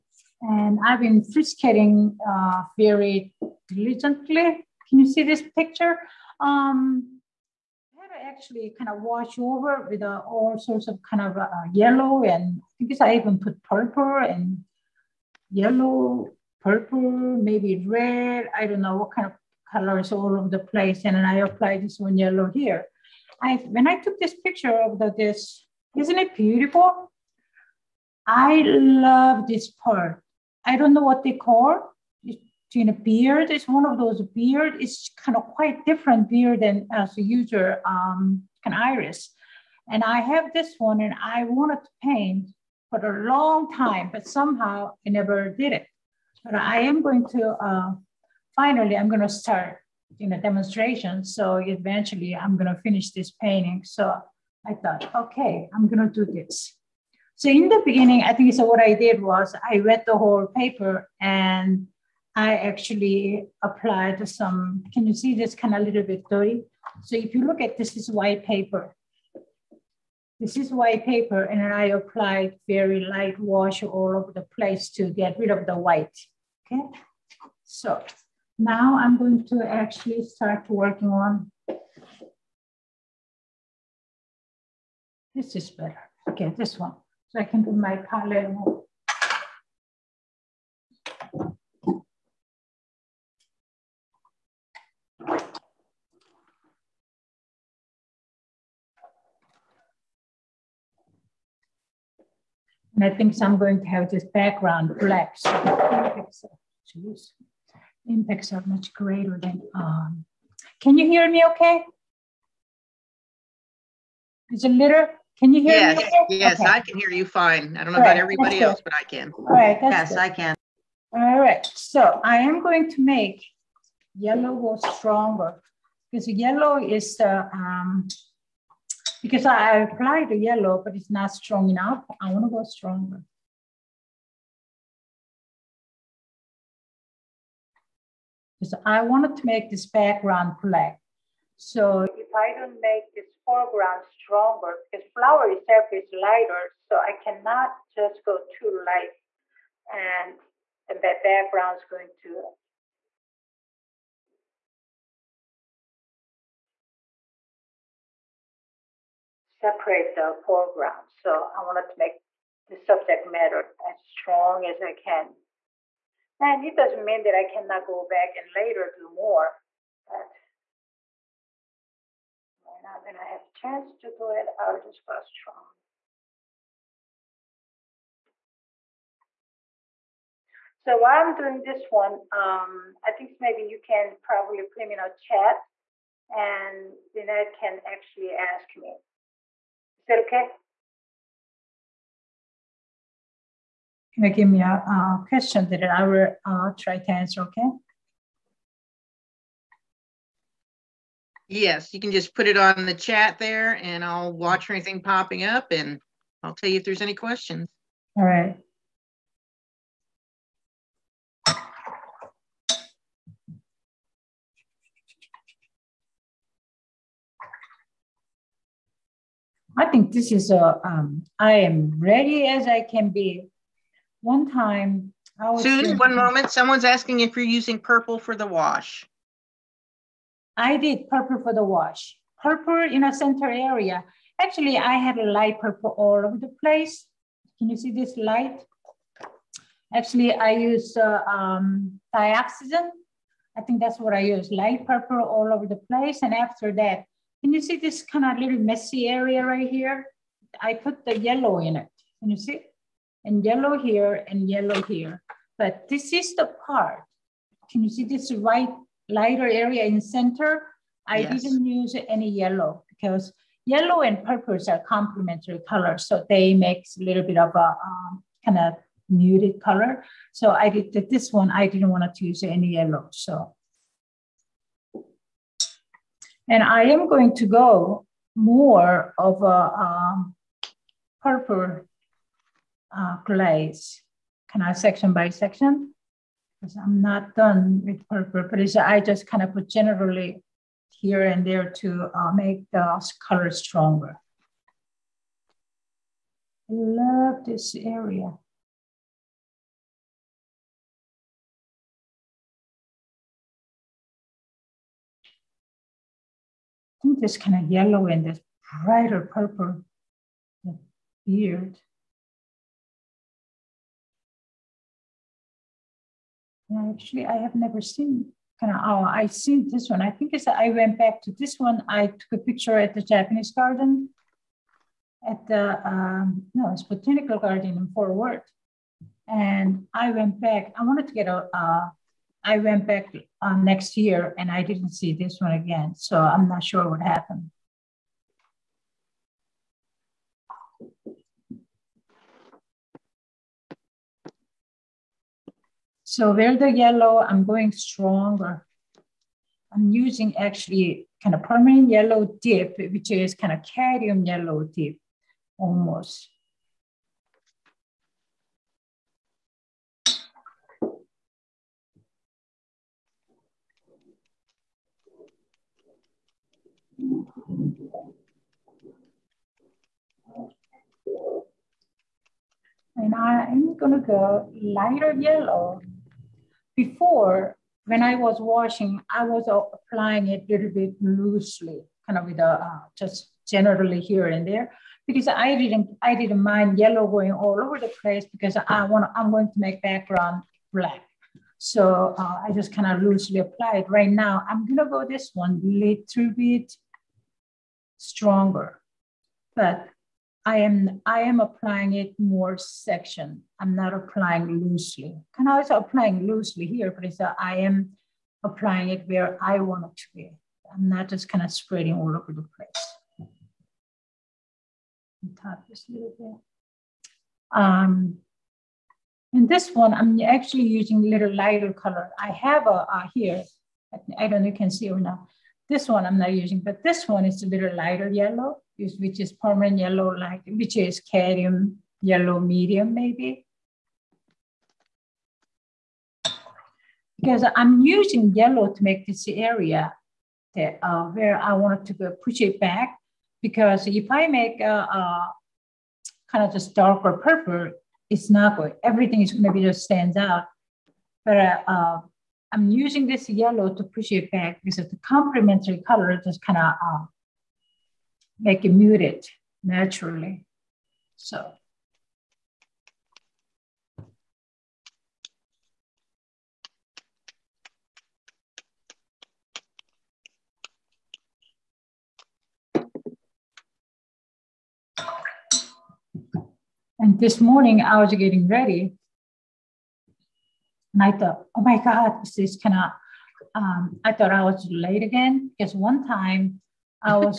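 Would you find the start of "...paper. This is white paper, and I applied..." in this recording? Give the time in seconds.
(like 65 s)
68 s.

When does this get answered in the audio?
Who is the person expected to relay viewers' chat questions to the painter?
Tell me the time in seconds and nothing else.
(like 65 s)
187 s.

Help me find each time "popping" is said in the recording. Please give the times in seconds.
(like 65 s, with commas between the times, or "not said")
205 s.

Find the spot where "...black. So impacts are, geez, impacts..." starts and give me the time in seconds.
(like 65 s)
104 s.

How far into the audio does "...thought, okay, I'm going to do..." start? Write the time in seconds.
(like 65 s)
54 s.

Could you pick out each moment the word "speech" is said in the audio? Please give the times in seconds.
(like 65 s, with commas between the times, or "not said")
not said.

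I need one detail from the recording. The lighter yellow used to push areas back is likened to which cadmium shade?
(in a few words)
Cadmium yellow medium.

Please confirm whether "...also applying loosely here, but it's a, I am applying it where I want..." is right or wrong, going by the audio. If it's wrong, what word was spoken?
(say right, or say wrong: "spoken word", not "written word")
right.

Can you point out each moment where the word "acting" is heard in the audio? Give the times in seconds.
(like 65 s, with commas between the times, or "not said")
not said.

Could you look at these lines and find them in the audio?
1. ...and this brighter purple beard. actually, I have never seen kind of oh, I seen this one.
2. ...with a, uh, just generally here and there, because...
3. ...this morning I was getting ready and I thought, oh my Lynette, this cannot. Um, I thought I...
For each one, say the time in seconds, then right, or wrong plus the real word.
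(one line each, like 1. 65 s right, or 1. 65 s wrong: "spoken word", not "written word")
1. 308 s right
2. 382 s right
3. 477 s wrong: "God", not "Lynette".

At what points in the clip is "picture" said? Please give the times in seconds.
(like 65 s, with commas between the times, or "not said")
5 s, 24 s, 322 s.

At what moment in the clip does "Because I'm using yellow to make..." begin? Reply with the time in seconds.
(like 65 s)
437 s.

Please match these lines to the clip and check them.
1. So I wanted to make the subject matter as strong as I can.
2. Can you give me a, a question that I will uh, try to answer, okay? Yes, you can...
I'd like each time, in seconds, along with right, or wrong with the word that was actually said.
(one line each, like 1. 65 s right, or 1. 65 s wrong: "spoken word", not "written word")
1. 161 s right
2. 194 s right.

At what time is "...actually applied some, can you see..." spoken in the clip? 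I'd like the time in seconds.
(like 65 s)
62 s.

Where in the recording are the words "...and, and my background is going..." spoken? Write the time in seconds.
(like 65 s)
149 s.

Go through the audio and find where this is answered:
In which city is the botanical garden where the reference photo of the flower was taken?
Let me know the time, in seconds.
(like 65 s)
327 s.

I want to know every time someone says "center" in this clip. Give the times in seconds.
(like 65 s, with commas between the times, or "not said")
233 s, 259 s.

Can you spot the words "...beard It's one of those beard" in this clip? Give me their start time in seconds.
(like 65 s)
33 s.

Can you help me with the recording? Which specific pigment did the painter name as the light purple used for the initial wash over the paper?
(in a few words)
Dioxazine.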